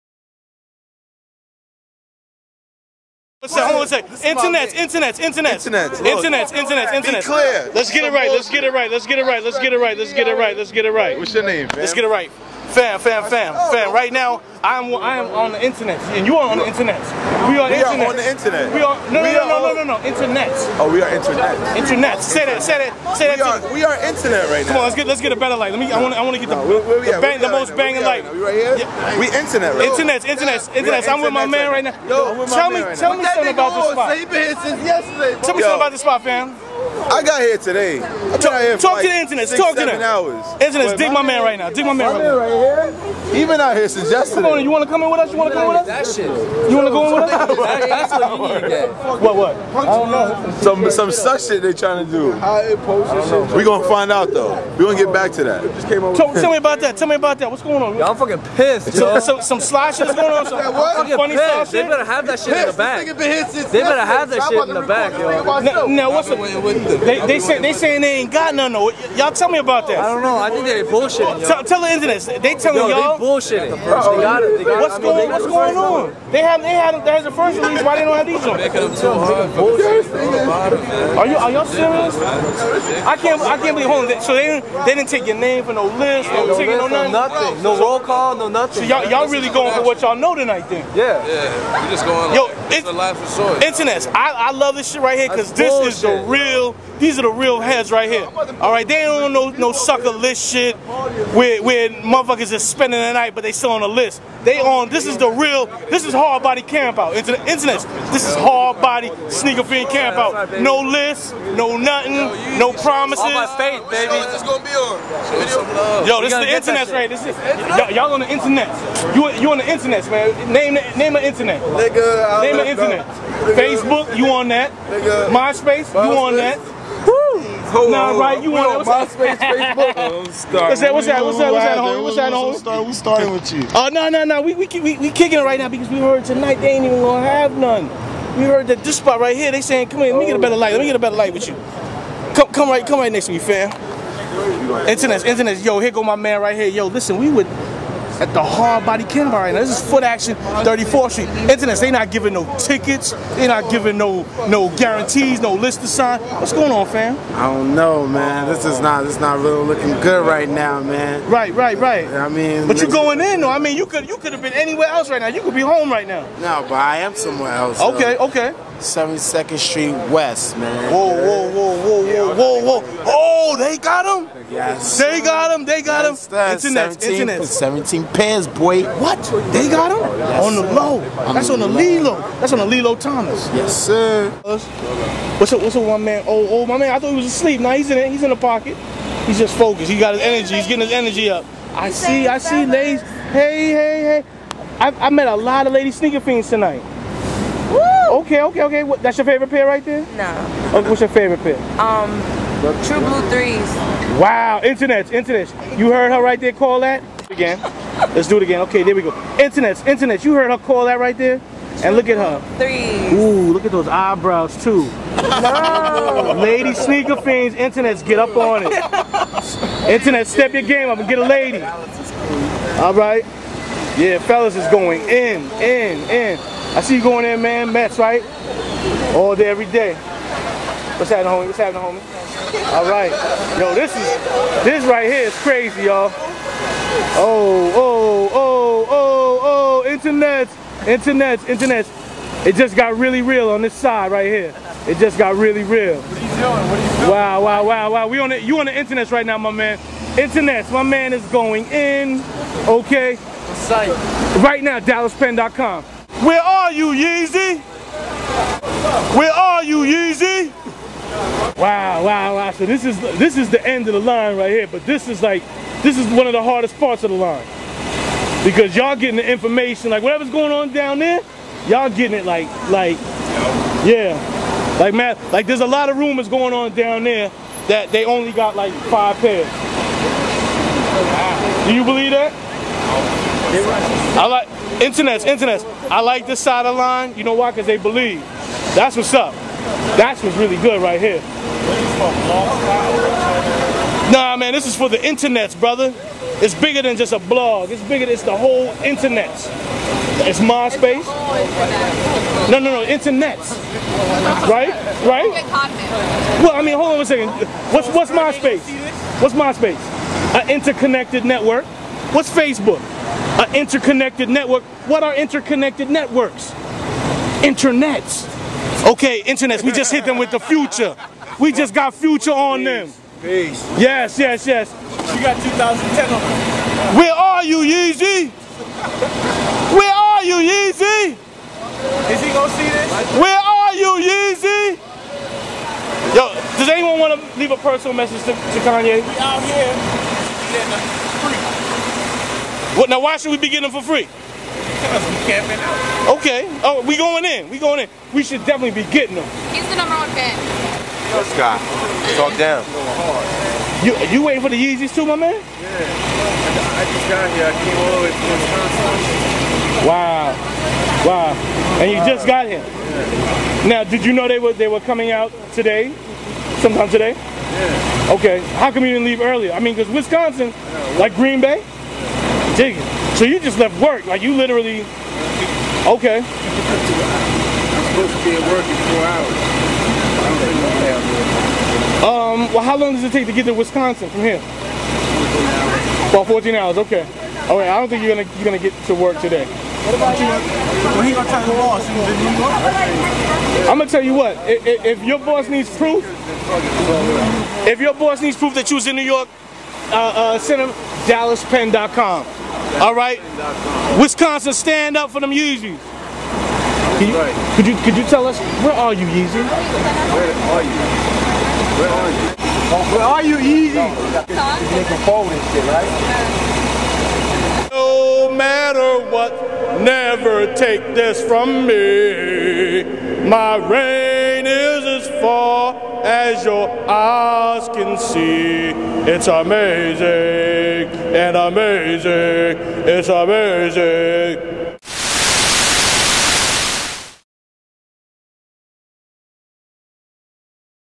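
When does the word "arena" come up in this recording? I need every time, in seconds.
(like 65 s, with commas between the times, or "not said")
not said.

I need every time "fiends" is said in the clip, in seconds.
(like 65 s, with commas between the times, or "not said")
109 s, 196 s, 217 s.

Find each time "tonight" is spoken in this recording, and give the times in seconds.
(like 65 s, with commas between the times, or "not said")
90 s, 136 s, 196 s.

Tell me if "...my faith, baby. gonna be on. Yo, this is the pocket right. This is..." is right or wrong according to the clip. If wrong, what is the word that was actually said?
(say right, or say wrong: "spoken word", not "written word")
wrong: "internet", not "pocket".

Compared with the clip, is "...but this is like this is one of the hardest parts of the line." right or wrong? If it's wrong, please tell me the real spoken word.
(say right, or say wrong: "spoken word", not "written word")
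right.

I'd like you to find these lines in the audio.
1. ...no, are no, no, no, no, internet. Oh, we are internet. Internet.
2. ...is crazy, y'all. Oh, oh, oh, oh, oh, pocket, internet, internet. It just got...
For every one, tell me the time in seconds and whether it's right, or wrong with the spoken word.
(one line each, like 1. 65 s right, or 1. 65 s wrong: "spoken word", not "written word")
1. 19 s right
2. 235 s wrong: "internet", not "pocket".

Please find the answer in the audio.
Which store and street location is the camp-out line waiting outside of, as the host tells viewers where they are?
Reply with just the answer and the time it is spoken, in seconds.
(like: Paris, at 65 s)
Footaction 34th Street, at 149 s.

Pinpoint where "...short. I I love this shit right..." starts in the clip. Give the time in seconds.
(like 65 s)
93 s.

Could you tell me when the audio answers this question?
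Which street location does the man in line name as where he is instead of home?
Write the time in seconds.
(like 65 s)
168 s.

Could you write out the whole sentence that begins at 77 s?
Why they don't have these on?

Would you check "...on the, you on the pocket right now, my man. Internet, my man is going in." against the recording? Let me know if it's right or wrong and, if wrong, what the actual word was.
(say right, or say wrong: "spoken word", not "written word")
wrong: "internet", not "pocket".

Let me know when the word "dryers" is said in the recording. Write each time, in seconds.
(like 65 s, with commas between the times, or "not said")
not said.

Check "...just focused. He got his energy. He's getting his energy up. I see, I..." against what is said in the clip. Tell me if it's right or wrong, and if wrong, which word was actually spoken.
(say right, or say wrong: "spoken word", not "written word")
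right.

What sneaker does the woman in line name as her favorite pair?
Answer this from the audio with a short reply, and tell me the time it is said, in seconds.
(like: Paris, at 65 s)
True Blue Threes, at 202 s.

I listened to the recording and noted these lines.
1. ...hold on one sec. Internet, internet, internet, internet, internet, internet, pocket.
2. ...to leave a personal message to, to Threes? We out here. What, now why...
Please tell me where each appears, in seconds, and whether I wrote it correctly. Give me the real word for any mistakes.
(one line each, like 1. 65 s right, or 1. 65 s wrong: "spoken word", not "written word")
1. 3 s wrong: "internet", not "pocket"
2. 337 s wrong: "Kanye", not "Threes".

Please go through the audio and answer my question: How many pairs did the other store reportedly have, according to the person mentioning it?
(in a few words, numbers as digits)
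17.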